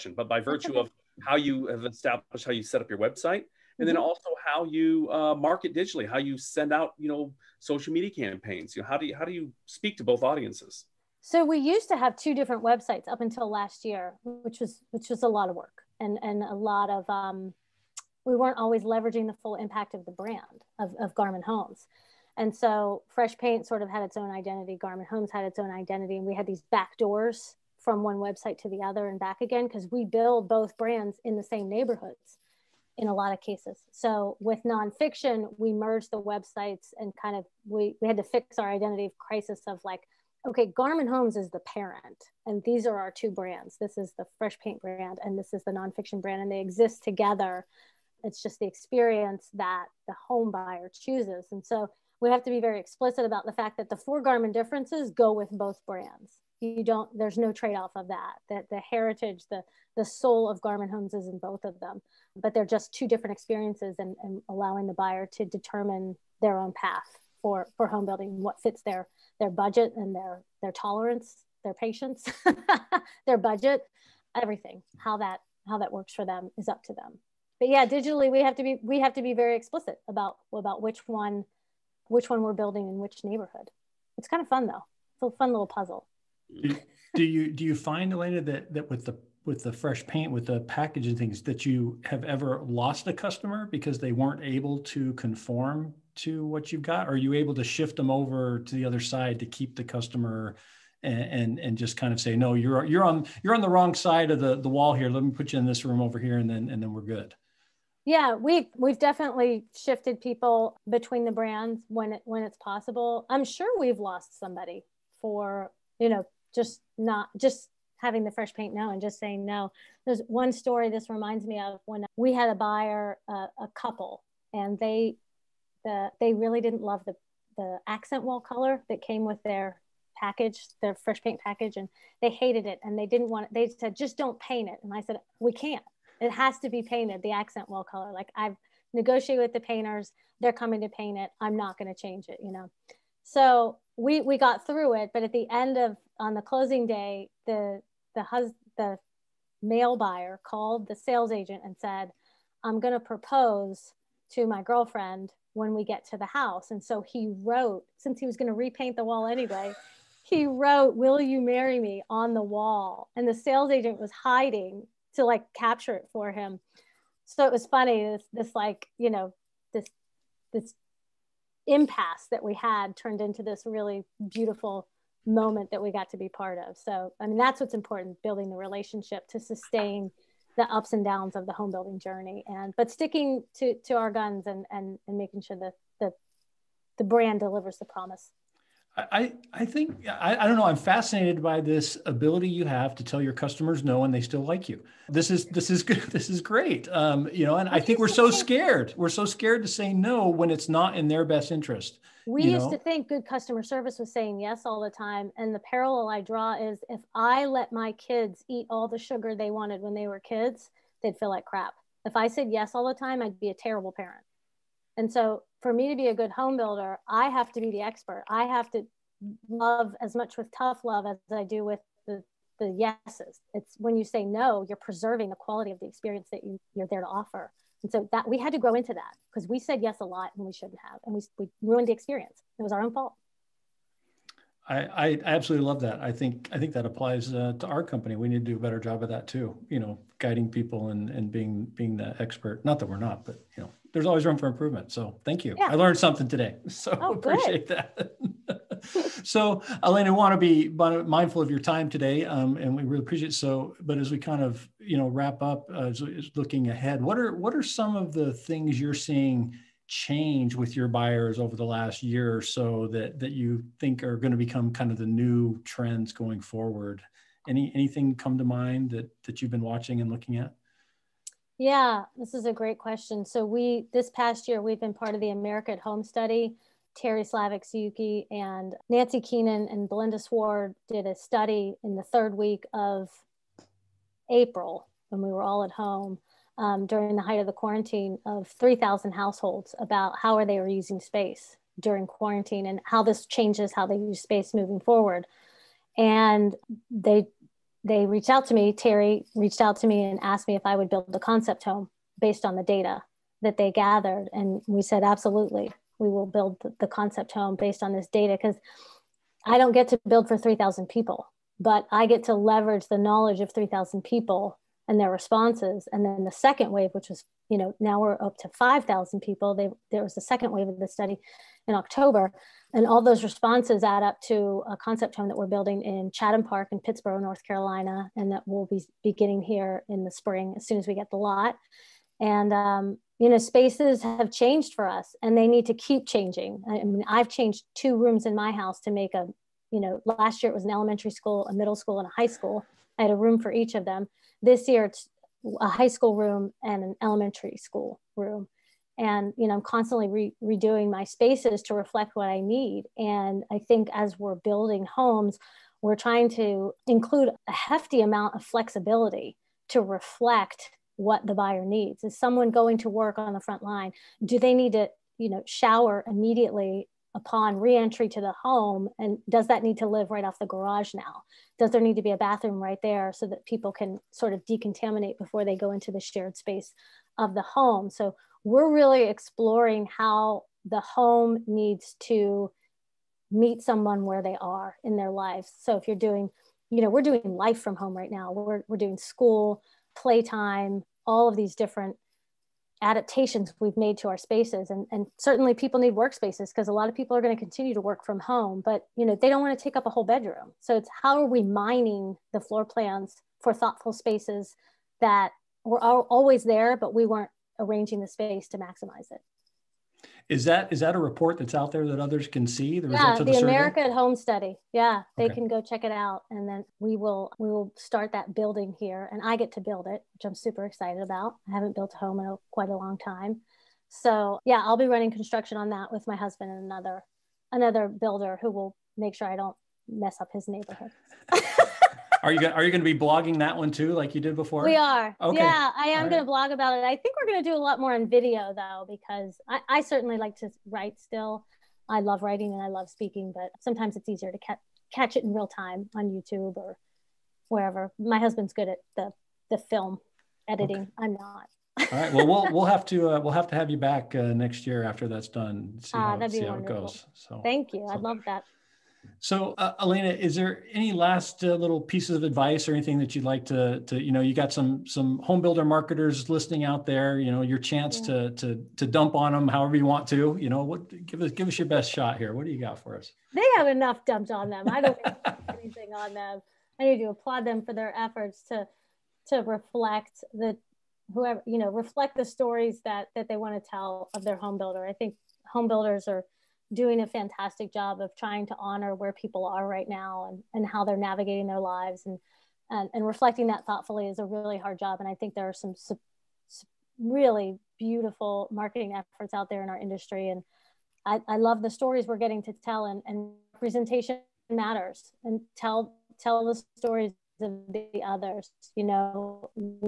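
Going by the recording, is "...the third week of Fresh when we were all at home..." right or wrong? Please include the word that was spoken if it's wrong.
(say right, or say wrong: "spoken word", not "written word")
wrong: "April", not "Fresh".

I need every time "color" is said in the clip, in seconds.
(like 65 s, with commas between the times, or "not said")
128 s, 137 s.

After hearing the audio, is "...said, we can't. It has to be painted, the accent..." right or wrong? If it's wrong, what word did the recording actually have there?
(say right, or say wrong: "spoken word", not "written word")
right.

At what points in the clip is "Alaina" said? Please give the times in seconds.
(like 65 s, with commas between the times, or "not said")
88 s, 249 s, 459 s.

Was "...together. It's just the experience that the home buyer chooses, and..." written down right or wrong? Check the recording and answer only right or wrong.
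right.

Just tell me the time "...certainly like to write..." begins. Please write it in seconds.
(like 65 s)
439 s.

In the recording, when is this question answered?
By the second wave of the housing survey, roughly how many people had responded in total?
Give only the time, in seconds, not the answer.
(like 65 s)
318 s.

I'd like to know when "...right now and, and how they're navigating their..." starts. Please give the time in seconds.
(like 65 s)
489 s.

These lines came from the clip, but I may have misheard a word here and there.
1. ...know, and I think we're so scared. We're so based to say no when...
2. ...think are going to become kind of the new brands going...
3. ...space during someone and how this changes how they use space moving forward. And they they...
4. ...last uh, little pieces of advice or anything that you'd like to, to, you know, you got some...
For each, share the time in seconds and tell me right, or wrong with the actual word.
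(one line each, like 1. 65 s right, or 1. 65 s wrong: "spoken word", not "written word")
1. 197 s wrong: "scared", not "based"
2. 263 s wrong: "trends", not "brands"
3. 290 s wrong: "quarantine", not "someone"
4. 460 s right.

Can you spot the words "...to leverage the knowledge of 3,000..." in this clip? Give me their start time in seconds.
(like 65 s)
312 s.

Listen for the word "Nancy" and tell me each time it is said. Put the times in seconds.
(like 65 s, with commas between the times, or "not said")
278 s.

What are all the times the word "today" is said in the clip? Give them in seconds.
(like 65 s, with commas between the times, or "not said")
246 s, 251 s.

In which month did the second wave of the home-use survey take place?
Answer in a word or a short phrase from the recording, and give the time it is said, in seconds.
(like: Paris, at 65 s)
October, at 321 s.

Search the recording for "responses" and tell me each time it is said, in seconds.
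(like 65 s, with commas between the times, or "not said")
315 s, 323 s.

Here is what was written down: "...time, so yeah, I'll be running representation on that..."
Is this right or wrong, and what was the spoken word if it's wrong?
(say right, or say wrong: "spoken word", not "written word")
wrong: "construction", not "representation".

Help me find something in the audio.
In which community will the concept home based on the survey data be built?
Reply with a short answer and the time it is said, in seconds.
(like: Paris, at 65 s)
Chatham Park, at 326 s.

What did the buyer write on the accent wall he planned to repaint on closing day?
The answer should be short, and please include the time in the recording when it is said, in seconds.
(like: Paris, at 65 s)
Will you marry me?, at 160 s.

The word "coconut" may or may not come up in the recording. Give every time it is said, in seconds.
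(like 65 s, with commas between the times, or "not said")
not said.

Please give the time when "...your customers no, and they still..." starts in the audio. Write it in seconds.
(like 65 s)
193 s.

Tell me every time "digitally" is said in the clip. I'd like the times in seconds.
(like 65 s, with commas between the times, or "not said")
5 s, 77 s.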